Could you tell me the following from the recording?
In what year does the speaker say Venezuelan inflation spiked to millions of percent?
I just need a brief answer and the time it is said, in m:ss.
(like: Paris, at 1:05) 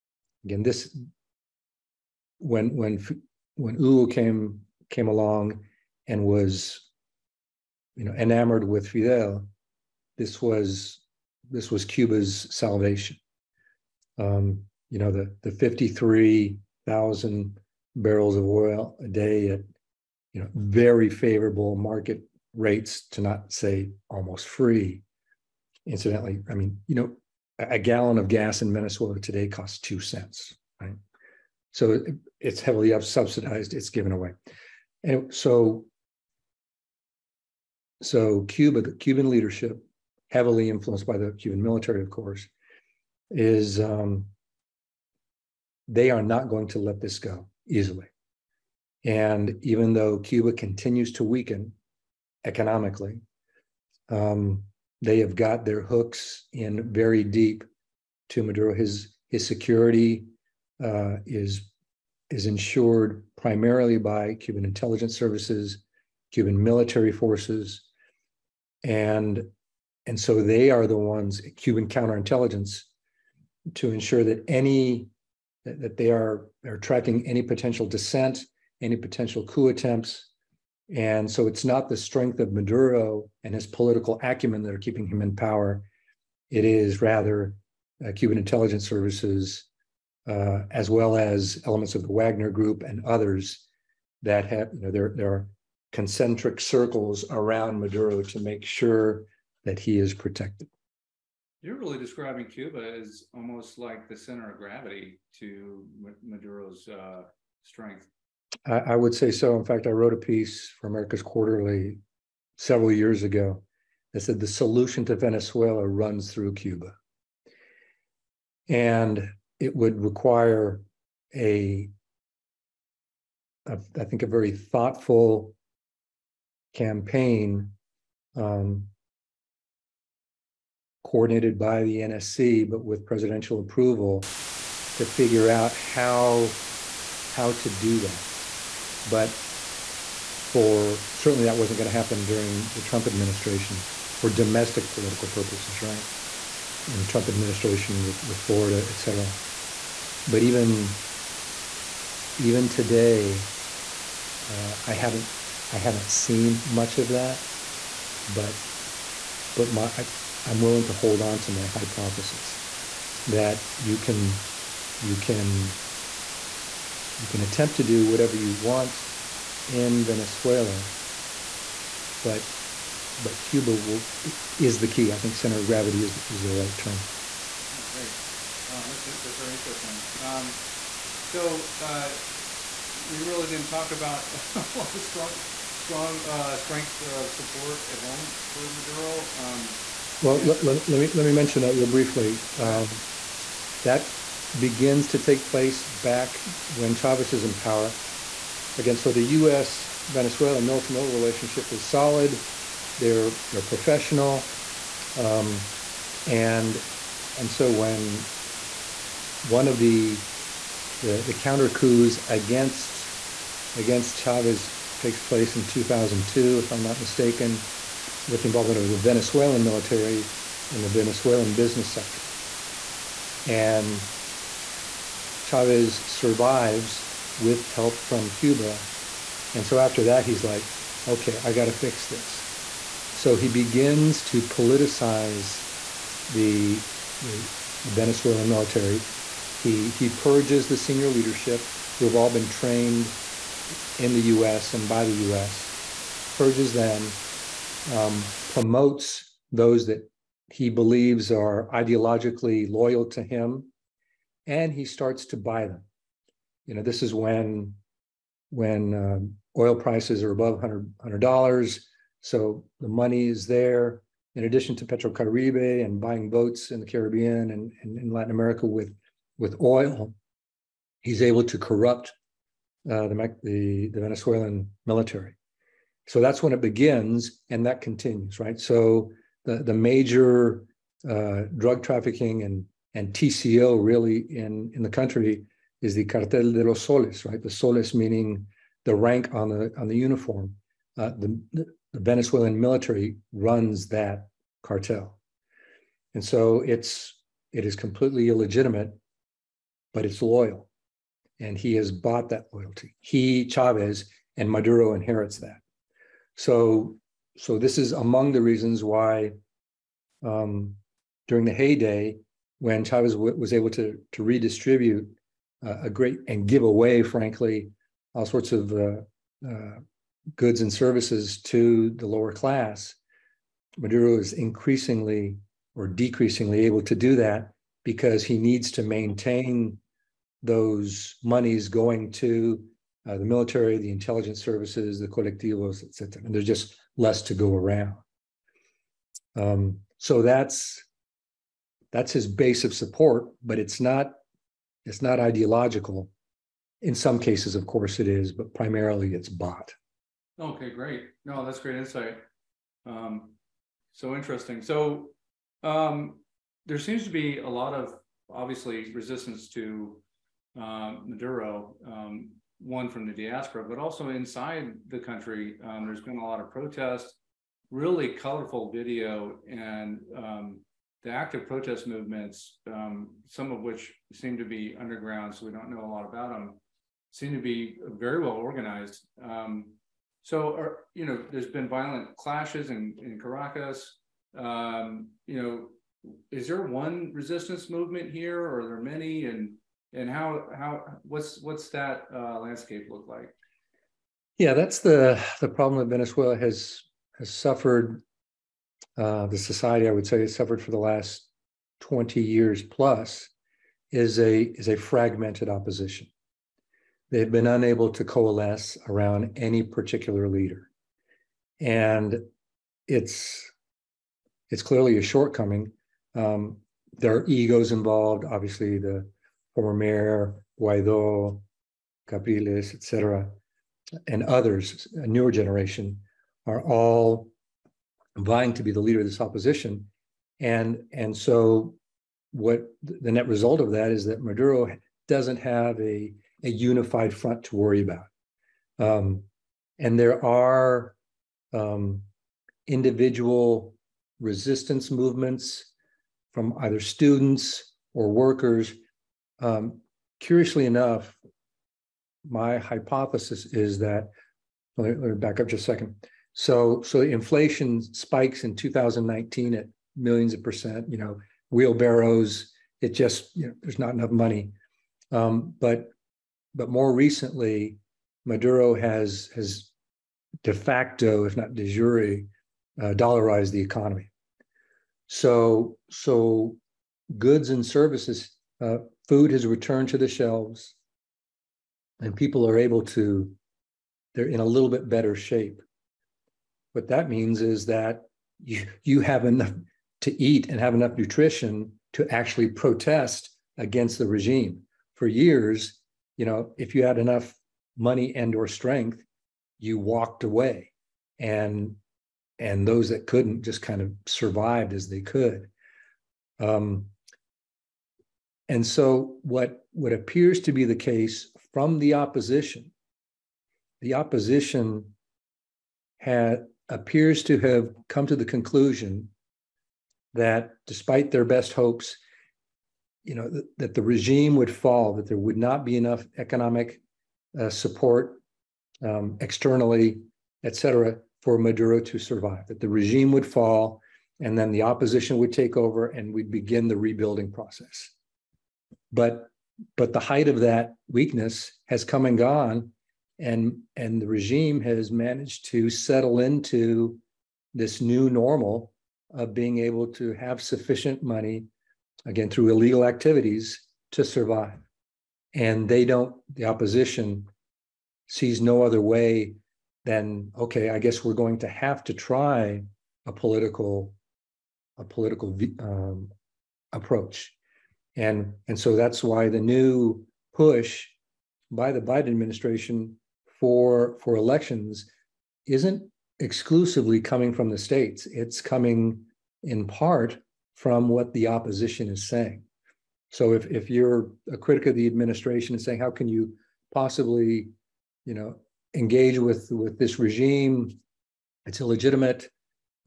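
2019, at 7:38.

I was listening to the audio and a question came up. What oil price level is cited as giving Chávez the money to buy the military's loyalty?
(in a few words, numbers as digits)
Above $100.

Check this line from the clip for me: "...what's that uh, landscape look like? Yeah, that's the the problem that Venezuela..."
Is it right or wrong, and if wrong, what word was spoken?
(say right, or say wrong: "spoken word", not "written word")
right.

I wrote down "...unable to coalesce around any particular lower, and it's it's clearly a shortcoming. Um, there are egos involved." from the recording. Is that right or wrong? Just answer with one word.
wrong.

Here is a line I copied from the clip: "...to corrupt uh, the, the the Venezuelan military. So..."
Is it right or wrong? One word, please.
right.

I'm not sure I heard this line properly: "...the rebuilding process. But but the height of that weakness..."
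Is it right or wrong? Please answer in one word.
right.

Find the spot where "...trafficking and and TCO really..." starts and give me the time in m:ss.
4:41.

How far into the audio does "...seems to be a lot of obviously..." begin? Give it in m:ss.
5:56.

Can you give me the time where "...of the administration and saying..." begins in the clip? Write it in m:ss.
9:44.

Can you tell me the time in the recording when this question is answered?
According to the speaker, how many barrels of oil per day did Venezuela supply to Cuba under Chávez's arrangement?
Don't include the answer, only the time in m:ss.
0:15.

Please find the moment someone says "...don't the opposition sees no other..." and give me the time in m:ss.
9:15.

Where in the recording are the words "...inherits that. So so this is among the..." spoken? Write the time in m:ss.
5:04.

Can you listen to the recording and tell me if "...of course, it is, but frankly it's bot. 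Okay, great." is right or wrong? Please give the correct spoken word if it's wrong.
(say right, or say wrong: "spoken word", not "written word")
wrong: "primarily", not "frankly".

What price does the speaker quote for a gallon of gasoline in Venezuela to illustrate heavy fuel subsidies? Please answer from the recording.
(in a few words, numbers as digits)
2 cents.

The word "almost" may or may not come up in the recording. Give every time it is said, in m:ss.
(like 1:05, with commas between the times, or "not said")
0:24, 1:43.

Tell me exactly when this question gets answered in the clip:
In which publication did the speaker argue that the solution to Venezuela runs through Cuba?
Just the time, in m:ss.
1:50.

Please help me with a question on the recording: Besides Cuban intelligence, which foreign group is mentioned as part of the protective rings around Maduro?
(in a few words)
Wagner Group.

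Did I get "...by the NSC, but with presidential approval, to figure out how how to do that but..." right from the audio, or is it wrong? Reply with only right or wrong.
right.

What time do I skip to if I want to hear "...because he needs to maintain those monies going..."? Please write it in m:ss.
5:27.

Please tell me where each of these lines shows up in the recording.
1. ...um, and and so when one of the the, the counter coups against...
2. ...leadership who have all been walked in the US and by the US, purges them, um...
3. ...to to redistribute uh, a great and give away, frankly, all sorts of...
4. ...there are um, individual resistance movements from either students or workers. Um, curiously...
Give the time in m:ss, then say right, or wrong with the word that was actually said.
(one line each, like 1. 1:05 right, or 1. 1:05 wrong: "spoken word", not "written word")
1. 3:25 right
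2. 4:01 wrong: "trained", not "walked"
3. 5:13 right
4. 7:19 right.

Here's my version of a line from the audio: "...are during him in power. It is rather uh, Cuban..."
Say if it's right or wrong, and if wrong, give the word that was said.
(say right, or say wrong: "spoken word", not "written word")
wrong: "keeping", not "during".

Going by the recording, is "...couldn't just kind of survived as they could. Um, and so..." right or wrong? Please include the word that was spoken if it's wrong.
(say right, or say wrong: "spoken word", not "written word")
right.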